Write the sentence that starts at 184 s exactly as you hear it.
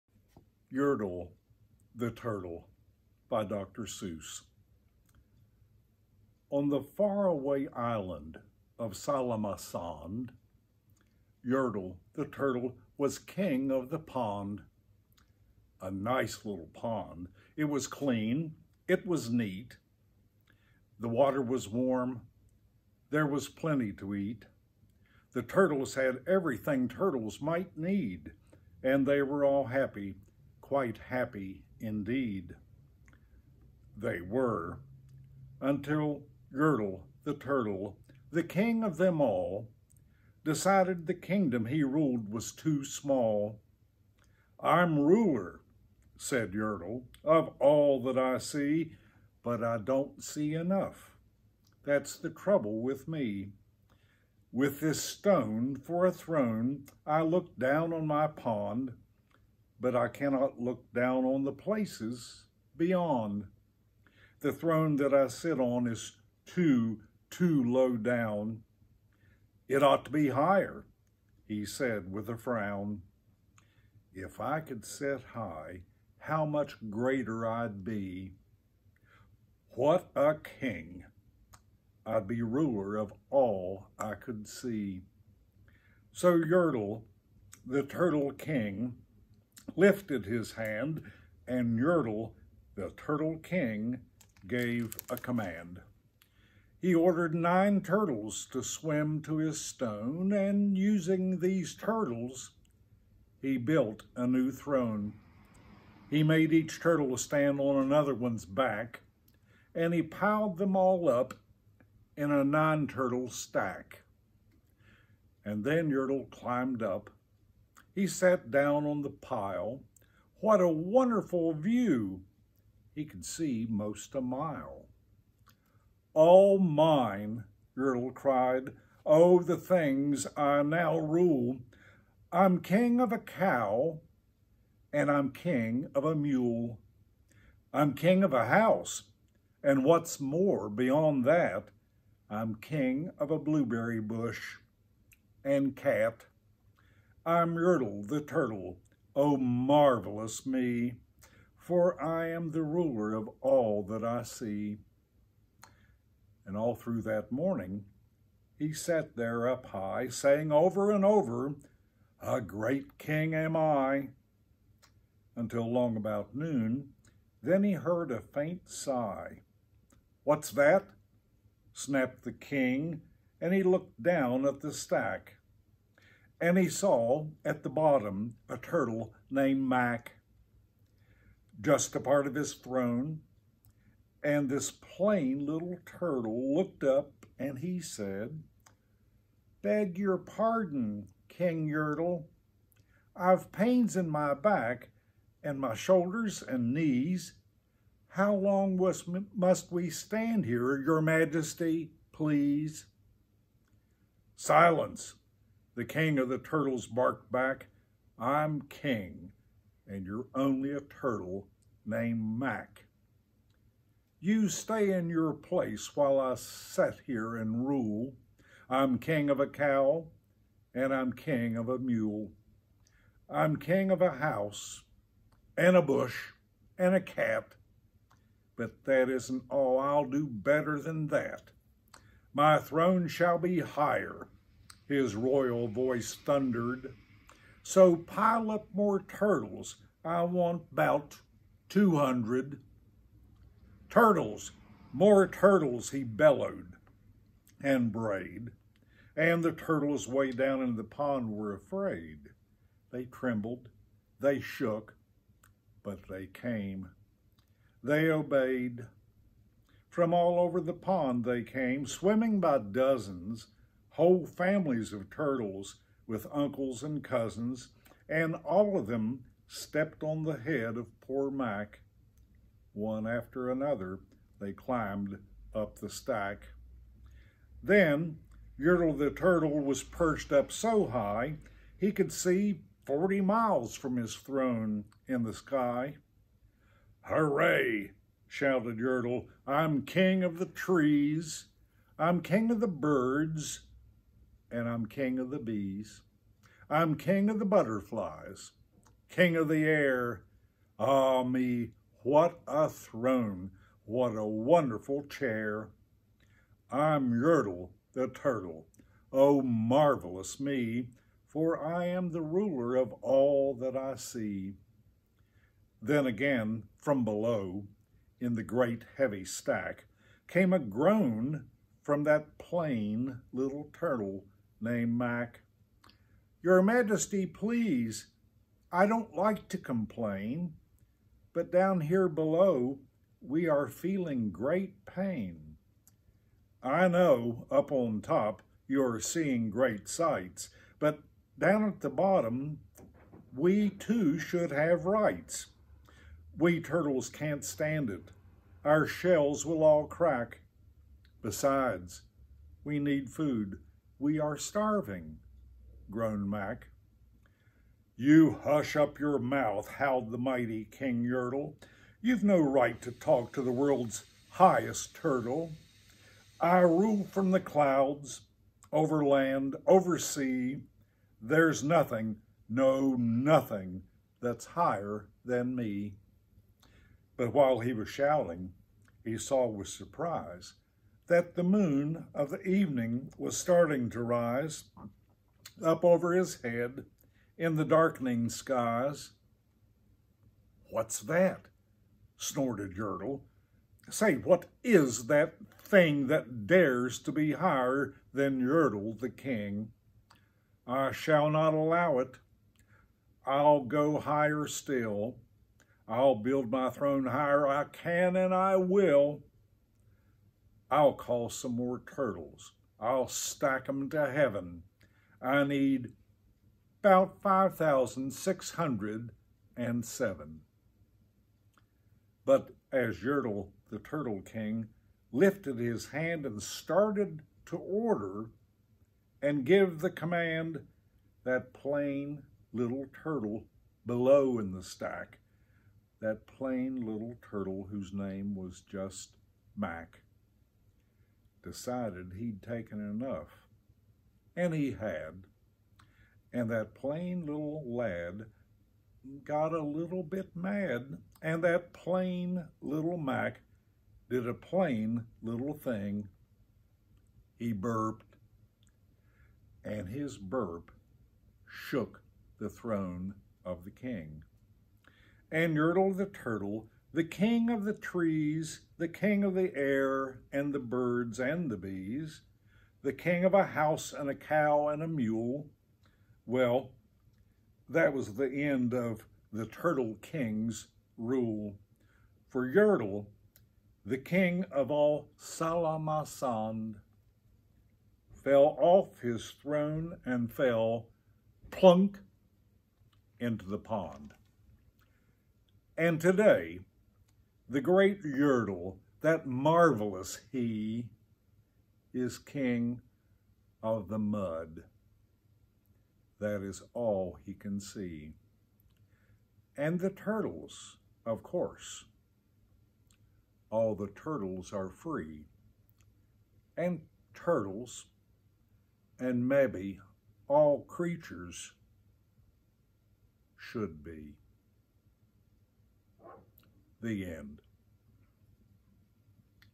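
And this plain little turtle looked up and he said, Beg your pardon, King Yertle.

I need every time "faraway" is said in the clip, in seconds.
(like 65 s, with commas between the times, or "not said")
6 s.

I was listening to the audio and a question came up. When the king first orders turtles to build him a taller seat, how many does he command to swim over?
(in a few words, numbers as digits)
9.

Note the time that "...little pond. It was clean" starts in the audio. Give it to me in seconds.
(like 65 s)
16 s.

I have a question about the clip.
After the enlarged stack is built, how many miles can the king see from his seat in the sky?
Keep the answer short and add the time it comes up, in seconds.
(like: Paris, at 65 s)
40, at 282 s.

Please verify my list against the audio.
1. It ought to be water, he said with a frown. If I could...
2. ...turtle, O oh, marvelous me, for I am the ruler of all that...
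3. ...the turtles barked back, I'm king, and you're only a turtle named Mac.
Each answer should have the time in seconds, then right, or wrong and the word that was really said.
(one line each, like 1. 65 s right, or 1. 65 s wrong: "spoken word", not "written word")
1. 69 s wrong: "higher", not "water"
2. 148 s right
3. 206 s right.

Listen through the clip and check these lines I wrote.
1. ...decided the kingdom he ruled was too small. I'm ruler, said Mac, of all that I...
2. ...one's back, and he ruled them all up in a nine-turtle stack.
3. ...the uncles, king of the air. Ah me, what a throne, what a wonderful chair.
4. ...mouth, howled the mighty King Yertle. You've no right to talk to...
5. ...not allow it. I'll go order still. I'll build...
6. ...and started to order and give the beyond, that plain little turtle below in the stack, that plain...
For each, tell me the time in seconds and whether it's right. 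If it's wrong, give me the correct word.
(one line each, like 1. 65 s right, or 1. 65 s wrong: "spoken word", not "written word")
1. 40 s wrong: "Yertle", not "Mac"
2. 108 s wrong: "piled", not "ruled"
3. 297 s wrong: "butterflies", not "uncles"
4. 359 s right
5. 401 s wrong: "higher", not "order"
6. 426 s wrong: "command", not "beyond".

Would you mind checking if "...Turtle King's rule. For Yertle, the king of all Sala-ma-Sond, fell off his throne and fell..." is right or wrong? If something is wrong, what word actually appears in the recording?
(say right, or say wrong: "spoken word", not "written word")
right.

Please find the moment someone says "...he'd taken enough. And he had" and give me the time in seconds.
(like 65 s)
442 s.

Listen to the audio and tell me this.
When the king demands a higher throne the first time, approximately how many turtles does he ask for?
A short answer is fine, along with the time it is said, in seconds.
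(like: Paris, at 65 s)
200, at 241 s.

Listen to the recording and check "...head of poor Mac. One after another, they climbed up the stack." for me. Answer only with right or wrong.
right.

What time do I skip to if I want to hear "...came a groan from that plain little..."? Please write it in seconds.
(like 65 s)
320 s.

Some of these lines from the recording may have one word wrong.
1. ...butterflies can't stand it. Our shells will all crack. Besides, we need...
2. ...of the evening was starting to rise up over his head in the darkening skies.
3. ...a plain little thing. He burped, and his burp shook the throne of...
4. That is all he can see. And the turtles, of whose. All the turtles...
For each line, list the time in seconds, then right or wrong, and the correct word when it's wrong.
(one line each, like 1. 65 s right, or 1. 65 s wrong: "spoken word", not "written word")
1. 346 s wrong: "turtles", not "butterflies"
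2. 382 s right
3. 454 s right
4. 506 s wrong: "course", not "whose".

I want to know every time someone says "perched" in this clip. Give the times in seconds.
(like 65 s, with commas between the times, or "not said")
279 s.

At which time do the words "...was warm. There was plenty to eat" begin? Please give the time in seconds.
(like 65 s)
21 s.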